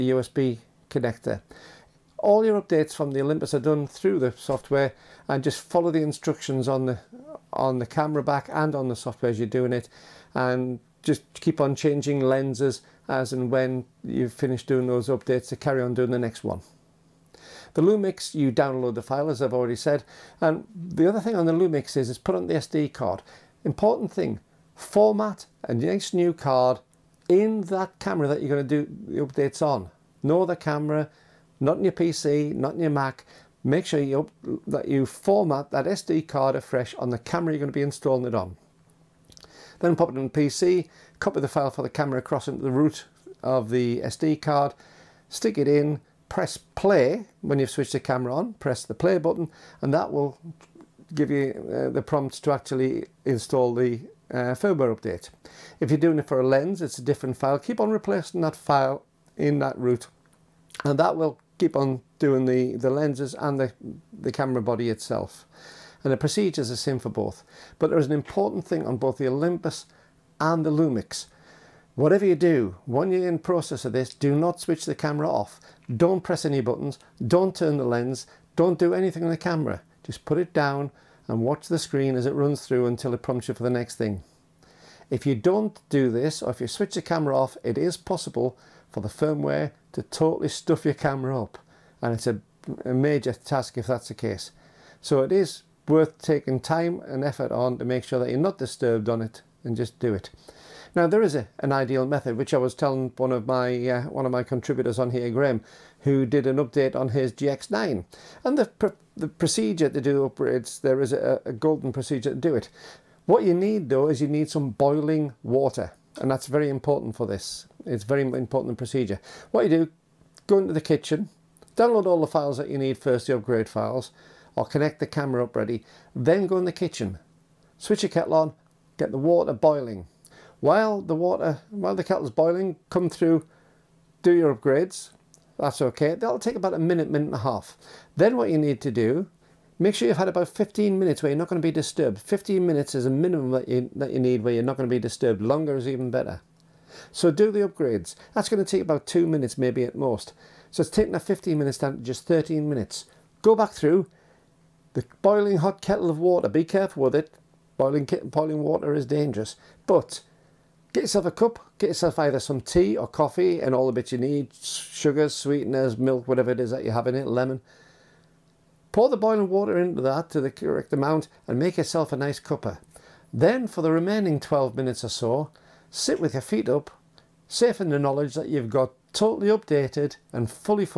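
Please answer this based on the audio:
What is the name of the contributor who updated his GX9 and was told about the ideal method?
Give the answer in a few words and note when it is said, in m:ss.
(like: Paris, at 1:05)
Graham, at 1:45.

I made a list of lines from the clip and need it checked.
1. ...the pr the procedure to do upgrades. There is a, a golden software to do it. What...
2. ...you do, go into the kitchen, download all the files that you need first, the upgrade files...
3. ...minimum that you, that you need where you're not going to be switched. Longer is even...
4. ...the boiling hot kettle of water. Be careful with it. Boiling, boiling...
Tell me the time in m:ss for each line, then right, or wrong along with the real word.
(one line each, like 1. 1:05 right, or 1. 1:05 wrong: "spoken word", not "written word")
1. 1:48 wrong: "procedure", not "software"
2. 1:59 right
3. 2:23 wrong: "disturbed", not "switched"
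4. 2:34 right.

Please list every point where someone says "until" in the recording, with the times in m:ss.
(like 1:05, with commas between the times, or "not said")
1:22.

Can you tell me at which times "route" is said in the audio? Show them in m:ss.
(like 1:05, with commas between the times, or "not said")
0:59.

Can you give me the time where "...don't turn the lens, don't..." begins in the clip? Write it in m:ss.
1:17.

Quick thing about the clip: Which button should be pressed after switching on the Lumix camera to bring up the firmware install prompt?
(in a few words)
Play button.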